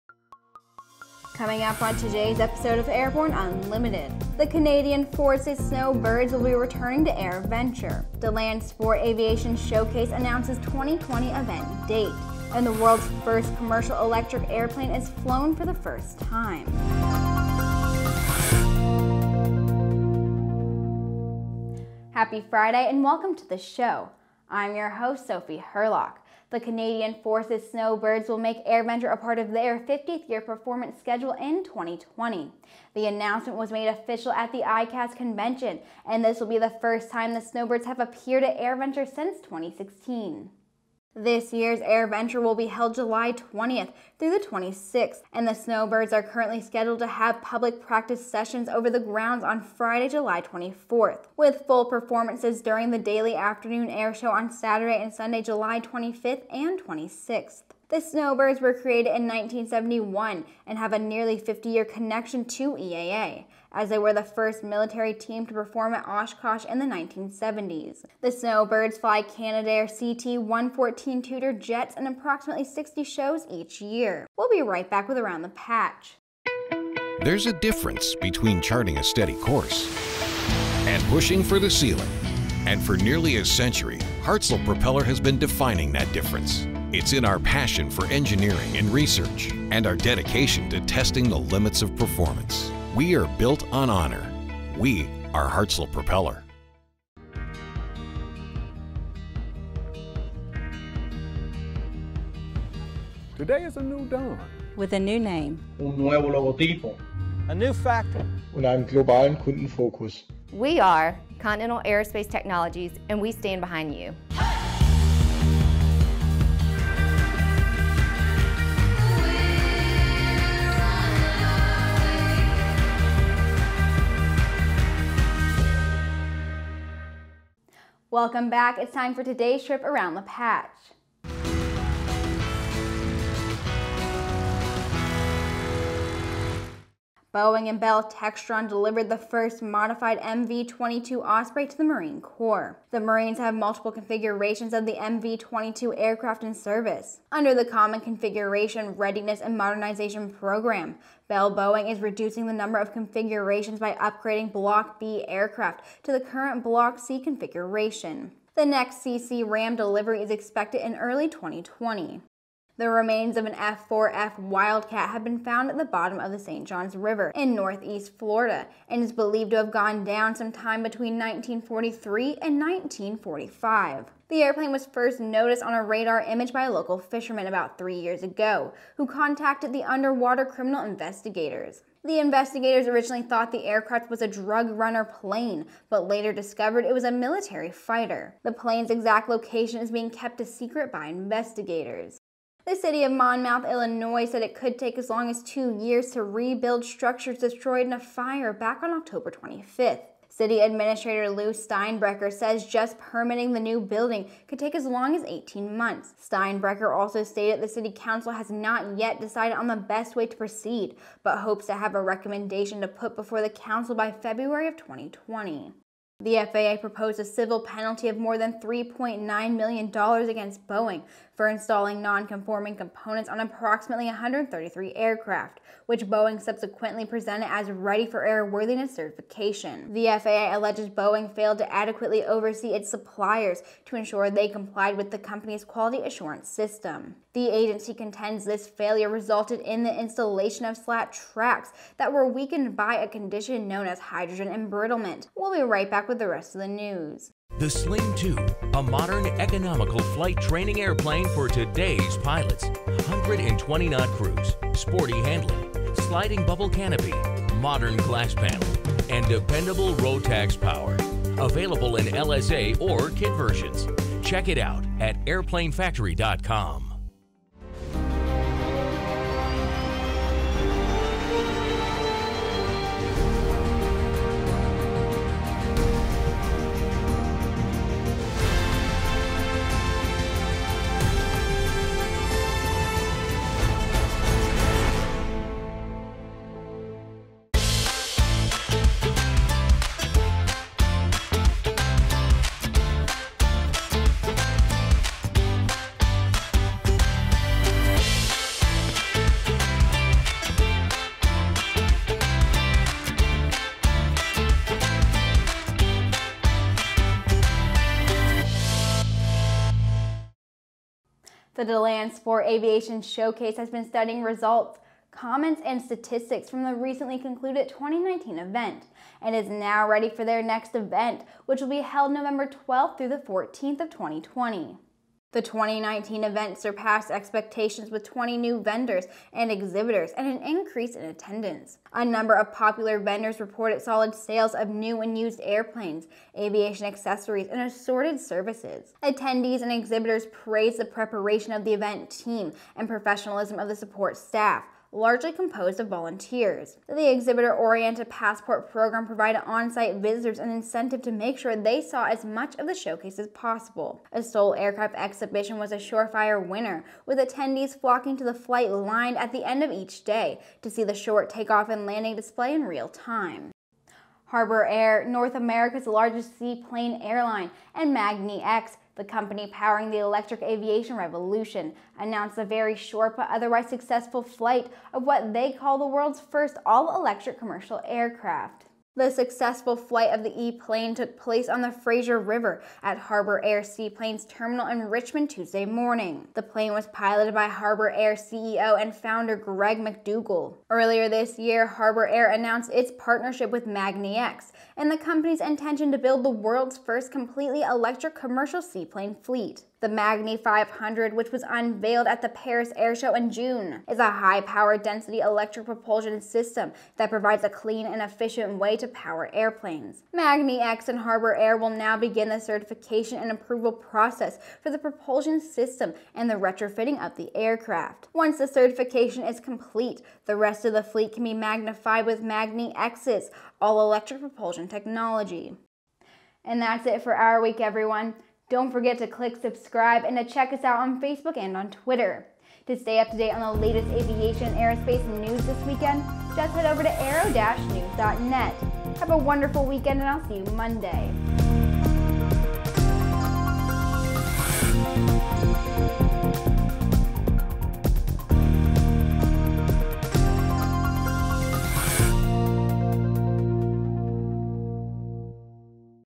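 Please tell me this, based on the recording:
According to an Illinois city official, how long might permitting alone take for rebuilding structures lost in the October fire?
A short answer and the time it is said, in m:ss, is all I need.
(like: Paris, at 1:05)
18 months, at 3:25.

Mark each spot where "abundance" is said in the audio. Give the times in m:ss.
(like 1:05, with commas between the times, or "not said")
not said.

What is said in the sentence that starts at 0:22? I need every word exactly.
Happy Friday and welcome to the show.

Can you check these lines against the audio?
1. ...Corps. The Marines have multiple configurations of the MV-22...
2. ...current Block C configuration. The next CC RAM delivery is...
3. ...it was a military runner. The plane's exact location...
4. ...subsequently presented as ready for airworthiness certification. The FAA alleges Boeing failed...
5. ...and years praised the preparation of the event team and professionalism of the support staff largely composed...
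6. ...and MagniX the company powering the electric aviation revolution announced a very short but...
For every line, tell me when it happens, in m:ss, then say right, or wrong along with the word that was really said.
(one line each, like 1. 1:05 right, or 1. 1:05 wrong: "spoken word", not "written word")
1. 2:22 right
2. 2:36 right
3. 3:06 wrong: "fighter", not "runner"
4. 3:46 right
5. 5:39 wrong: "exhibitors", not "years"
6. 6:07 right.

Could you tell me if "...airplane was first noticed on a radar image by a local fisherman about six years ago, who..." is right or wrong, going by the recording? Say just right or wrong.
wrong.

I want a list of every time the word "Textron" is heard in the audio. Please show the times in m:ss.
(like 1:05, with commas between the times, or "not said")
2:18.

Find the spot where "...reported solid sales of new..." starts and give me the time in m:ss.
5:33.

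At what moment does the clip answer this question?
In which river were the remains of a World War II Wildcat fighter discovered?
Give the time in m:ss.
2:46.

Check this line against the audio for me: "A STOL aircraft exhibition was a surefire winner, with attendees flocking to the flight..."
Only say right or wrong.
right.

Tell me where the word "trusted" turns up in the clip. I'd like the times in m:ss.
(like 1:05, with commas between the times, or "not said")
not said.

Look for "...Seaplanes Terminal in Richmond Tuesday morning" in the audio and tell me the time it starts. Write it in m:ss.
6:23.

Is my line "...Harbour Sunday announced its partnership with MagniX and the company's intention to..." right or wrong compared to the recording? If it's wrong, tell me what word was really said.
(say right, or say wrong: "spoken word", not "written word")
wrong: "Air", not "Sunday".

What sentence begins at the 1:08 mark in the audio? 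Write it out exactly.
The Snowbirds fly Canadair CT 114 Tutor jets in approximately 60 shows each year.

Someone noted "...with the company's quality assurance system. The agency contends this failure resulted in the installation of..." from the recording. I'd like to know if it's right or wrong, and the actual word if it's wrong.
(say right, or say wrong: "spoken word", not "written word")
right.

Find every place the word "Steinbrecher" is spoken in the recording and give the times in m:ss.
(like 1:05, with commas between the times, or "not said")
3:21, 3:26.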